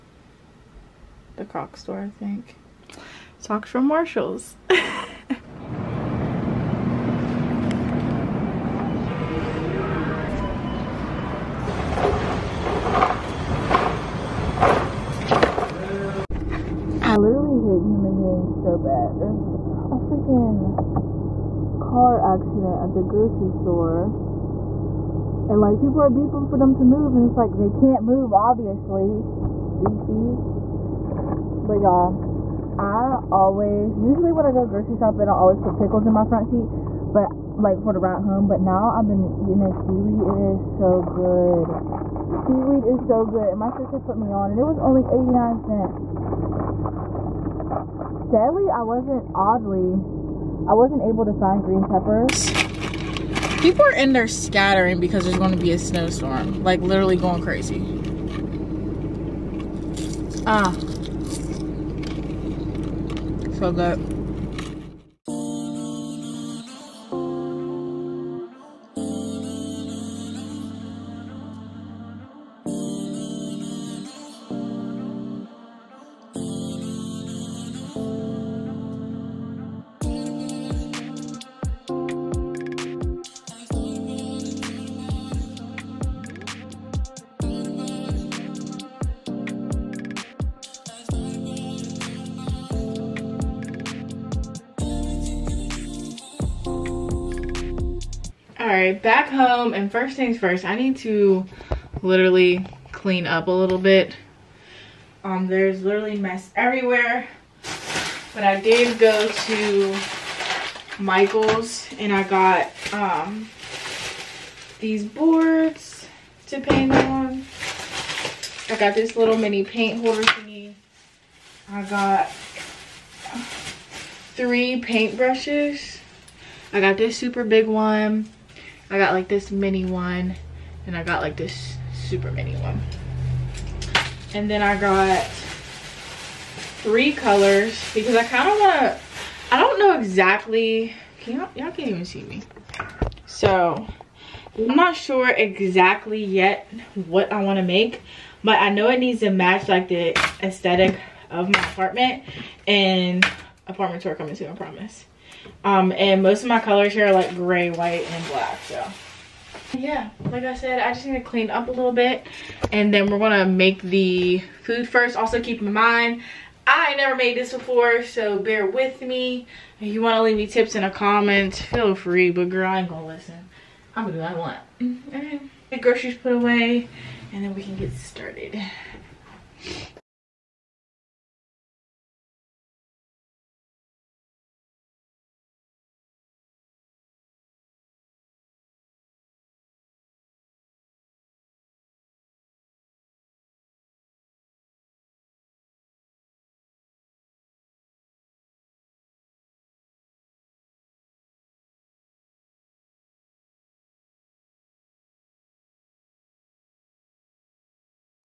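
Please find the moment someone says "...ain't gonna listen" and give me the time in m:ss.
2:52.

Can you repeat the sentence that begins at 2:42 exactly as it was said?
And then we're gonna make the food first.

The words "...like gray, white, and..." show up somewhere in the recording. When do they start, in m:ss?
2:37.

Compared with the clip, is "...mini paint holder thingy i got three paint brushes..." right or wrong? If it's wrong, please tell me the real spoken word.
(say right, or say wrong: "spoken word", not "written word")
right.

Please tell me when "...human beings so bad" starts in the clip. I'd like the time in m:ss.
0:17.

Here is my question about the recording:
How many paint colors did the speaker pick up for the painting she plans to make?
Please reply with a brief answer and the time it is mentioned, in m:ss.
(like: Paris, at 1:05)
3, at 2:16.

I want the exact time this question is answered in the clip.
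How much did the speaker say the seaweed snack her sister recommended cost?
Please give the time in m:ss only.
0:45.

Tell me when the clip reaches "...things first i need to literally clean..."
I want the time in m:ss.
1:40.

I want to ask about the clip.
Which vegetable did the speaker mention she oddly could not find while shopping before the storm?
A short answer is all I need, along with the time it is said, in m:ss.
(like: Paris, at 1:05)
green peppers, at 0:51.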